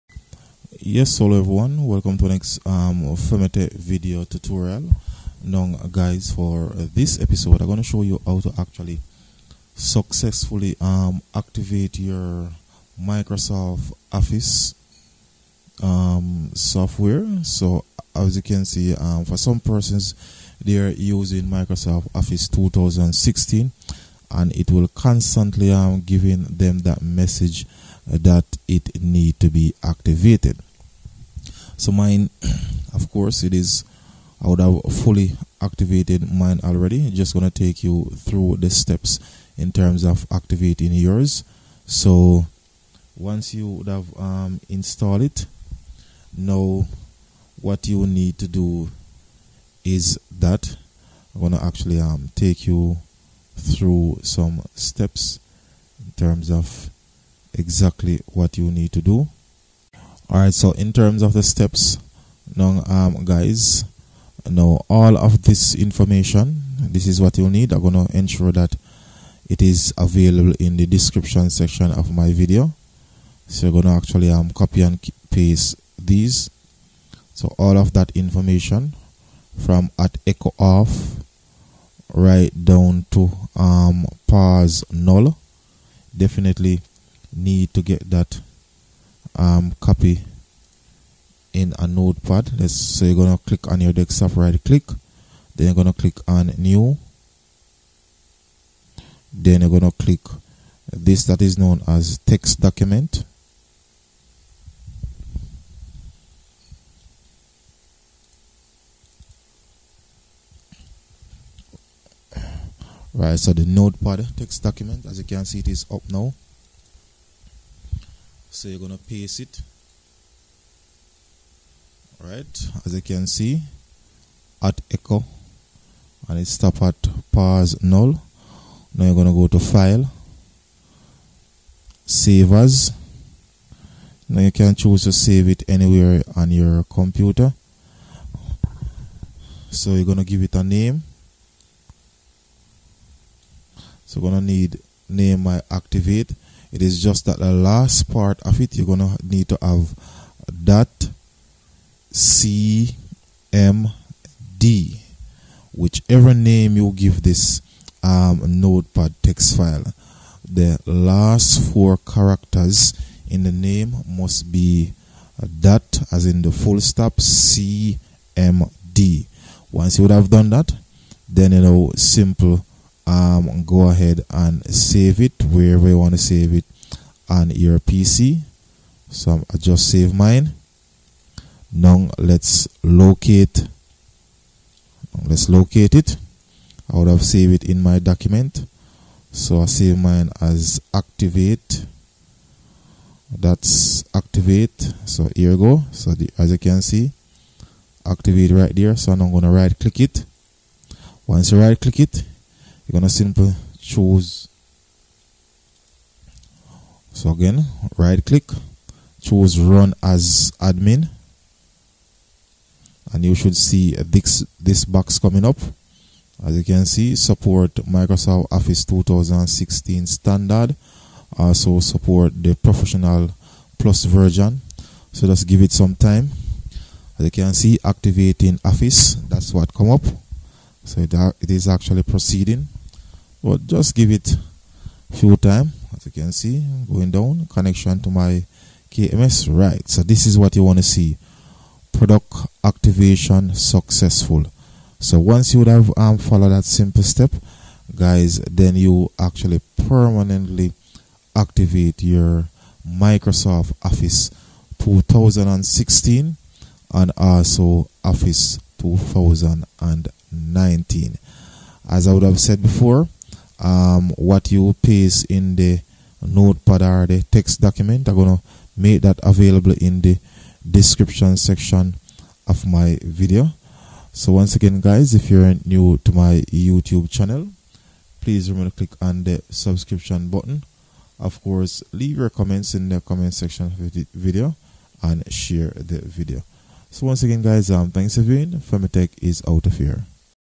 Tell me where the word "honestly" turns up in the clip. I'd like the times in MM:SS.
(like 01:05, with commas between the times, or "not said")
not said.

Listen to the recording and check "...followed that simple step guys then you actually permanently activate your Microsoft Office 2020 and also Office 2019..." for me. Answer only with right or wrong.
wrong.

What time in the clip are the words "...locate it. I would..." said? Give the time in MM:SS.
03:05.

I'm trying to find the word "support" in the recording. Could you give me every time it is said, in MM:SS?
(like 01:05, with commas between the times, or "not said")
03:37, 03:41.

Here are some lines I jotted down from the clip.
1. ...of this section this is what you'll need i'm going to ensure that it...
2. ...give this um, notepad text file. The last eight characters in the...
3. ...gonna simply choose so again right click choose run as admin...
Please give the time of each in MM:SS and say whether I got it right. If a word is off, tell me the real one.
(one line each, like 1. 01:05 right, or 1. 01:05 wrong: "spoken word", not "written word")
1. 01:05 wrong: "information", not "section"
2. 02:36 wrong: "four", not "eight"
3. 03:22 right.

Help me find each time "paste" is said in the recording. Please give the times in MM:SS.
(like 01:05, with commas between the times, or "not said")
01:15, 01:59, 04:24.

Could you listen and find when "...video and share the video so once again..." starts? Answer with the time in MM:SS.
04:44.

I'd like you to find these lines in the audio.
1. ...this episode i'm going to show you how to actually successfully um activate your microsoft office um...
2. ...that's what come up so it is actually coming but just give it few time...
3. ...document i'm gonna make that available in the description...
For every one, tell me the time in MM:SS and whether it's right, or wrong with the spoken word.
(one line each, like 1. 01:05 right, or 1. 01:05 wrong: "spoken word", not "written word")
1. 00:06 right
2. 03:49 wrong: "proceeding", not "coming"
3. 04:27 right.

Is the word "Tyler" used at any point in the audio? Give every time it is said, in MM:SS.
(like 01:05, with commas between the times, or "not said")
not said.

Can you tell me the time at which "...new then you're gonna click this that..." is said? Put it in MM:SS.
01:36.